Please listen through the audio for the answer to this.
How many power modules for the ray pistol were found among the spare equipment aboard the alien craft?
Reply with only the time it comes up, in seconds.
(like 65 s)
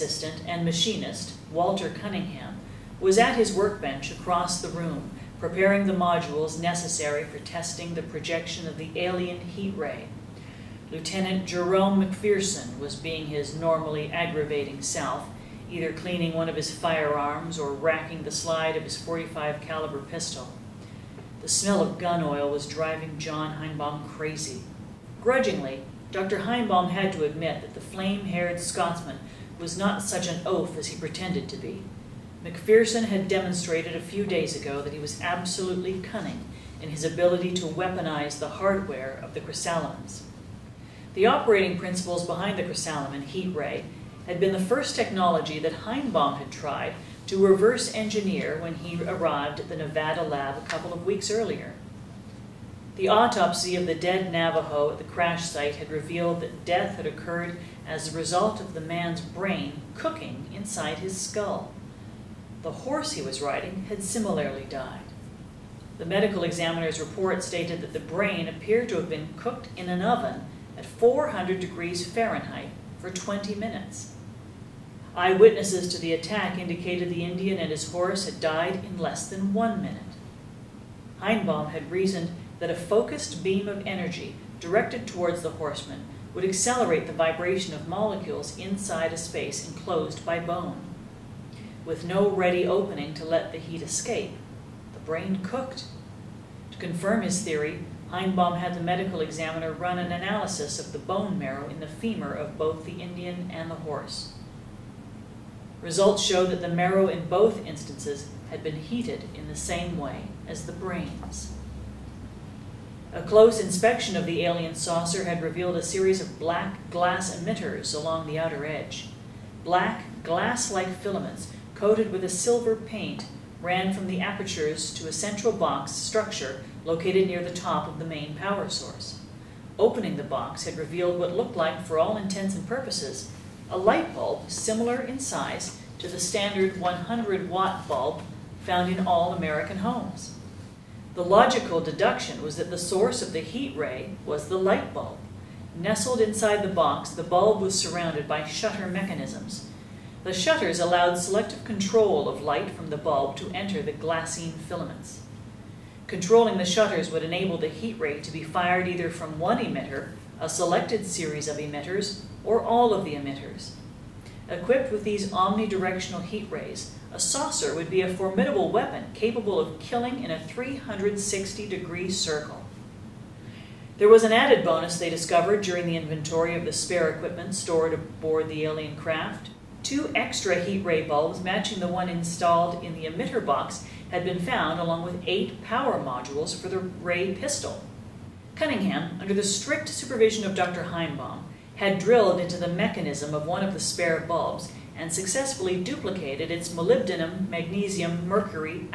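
185 s.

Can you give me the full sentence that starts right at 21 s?
The smell of gun oil was driving John Heinbaum crazy.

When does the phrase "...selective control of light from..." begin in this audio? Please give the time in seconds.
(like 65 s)
151 s.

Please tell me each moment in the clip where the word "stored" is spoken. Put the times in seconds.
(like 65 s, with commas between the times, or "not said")
177 s.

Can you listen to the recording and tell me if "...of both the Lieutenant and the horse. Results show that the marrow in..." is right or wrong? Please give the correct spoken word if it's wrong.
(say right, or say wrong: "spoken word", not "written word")
wrong: "Indian", not "Lieutenant".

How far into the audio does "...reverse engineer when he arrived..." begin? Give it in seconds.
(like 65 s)
47 s.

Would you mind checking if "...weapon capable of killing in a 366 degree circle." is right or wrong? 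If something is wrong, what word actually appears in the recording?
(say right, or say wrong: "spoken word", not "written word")
wrong: "360", not "366".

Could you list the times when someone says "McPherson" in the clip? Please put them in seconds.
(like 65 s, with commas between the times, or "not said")
12 s, 32 s.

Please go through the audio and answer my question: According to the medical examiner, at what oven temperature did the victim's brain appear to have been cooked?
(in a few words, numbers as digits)
400 degrees Fahrenheit.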